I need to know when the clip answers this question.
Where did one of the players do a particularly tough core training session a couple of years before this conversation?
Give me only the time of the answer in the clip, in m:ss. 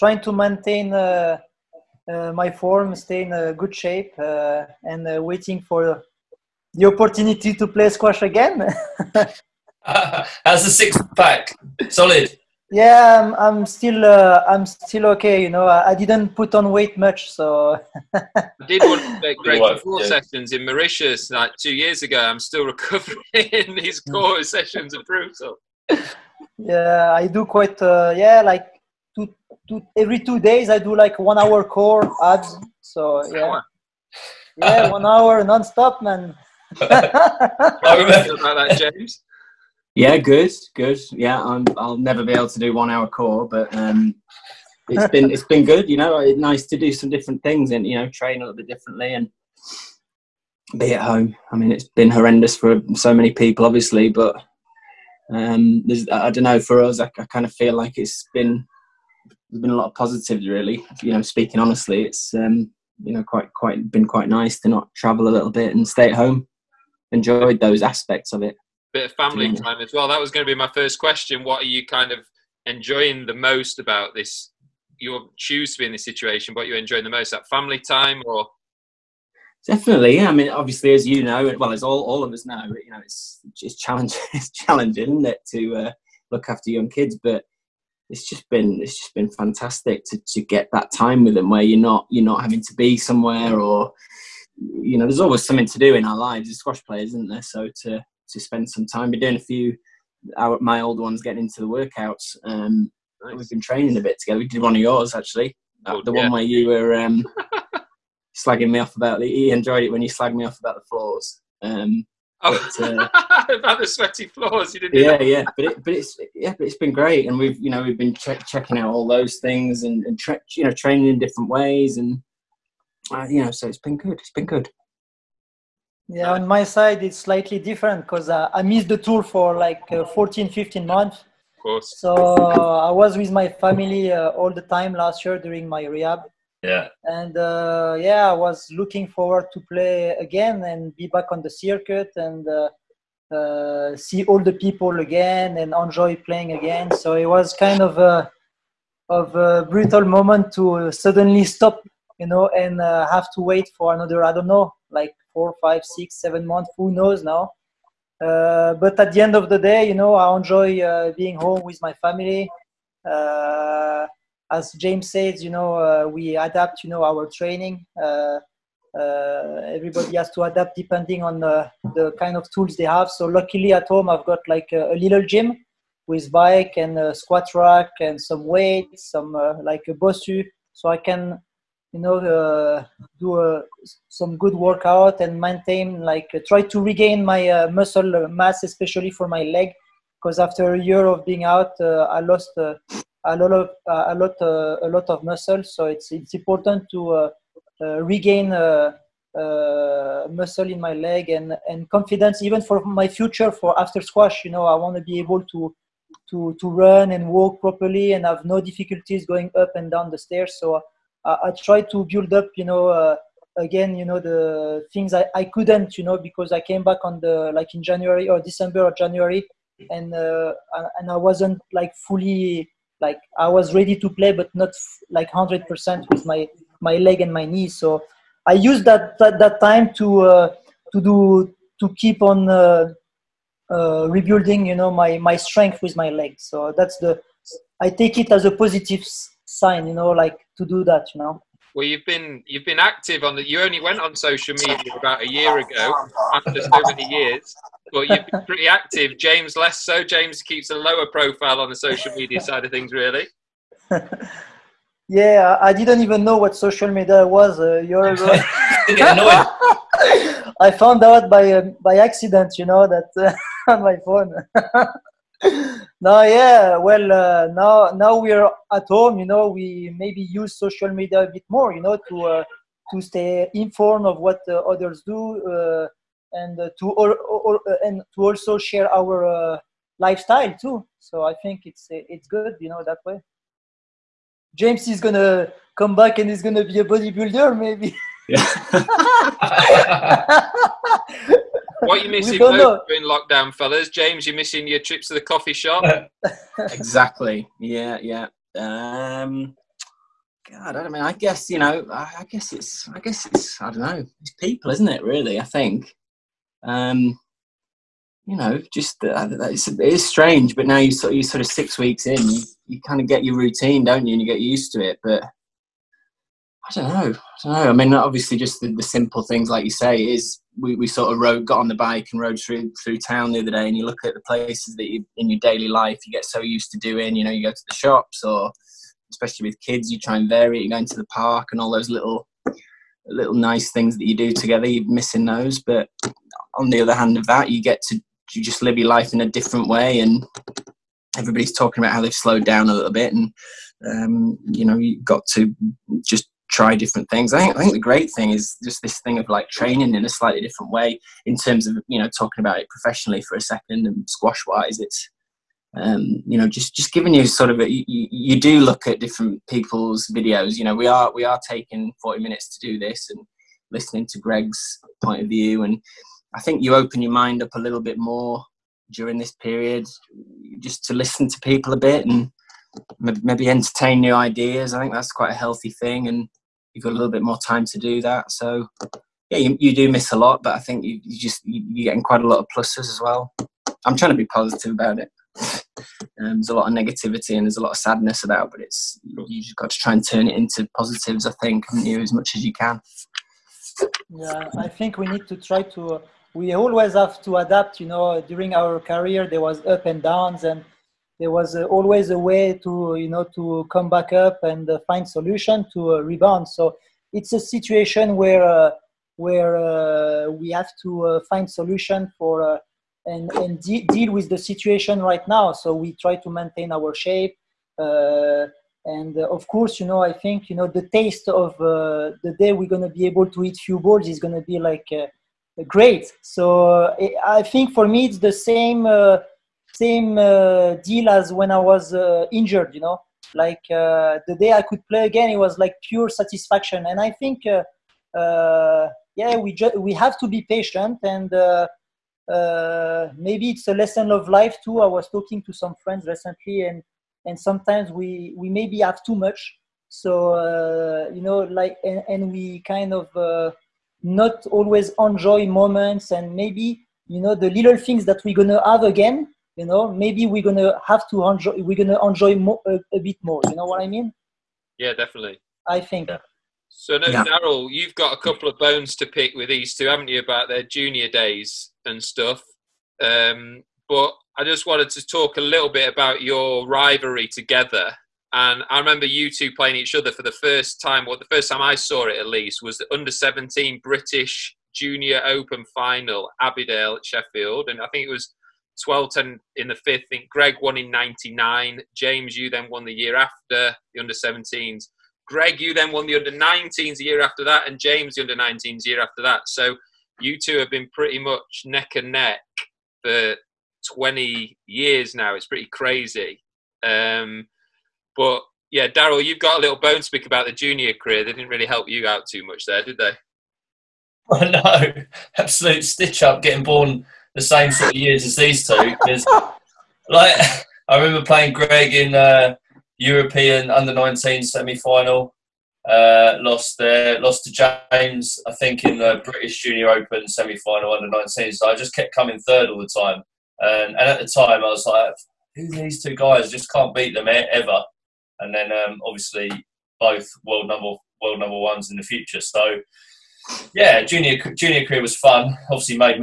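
0:20.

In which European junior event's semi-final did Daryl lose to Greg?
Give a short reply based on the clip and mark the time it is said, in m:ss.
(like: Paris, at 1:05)
European under 19, at 8:42.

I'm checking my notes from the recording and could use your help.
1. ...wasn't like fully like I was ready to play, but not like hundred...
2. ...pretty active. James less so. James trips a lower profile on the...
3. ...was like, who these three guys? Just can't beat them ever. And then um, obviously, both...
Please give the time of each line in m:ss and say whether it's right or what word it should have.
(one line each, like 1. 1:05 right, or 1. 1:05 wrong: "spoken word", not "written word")
1. 3:41 right
2. 4:08 wrong: "keeps", not "trips"
3. 8:54 wrong: "two", not "three".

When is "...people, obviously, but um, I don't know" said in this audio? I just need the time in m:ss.
0:53.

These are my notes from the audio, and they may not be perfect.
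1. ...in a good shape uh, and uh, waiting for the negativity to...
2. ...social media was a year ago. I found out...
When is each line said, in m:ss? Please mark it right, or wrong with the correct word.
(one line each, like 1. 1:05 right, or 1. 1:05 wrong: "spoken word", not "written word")
1. 0:03 wrong: "opportunity", not "negativity"
2. 4:16 right.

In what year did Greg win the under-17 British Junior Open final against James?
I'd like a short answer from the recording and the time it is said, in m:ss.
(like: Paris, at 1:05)
1999, at 8:10.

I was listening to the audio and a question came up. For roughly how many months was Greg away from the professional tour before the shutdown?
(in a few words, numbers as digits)
14 or 15 months.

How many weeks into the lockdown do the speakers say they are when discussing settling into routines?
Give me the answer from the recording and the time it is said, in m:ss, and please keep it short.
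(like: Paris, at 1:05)
6 weeks, at 5:11.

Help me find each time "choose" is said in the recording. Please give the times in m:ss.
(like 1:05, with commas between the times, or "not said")
1:15.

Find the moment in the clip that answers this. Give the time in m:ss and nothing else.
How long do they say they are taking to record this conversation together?
6:02.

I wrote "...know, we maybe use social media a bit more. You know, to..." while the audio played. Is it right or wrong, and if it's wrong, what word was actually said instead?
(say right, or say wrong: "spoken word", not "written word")
right.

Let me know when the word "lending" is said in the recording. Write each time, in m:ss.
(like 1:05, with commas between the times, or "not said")
not said.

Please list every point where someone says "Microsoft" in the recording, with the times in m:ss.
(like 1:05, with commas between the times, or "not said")
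not said.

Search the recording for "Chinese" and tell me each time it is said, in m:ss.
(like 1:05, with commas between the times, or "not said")
not said.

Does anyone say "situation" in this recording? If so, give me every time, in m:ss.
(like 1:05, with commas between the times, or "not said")
1:16, 6:47, 6:54.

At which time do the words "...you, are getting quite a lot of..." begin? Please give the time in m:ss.
6:21.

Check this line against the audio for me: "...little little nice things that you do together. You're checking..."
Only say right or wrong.
wrong.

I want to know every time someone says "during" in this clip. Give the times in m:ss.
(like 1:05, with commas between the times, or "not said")
2:15, 6:08, 6:38.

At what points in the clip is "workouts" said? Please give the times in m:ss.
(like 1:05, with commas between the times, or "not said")
1:41, 3:04.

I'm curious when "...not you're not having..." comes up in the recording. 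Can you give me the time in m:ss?
1:31.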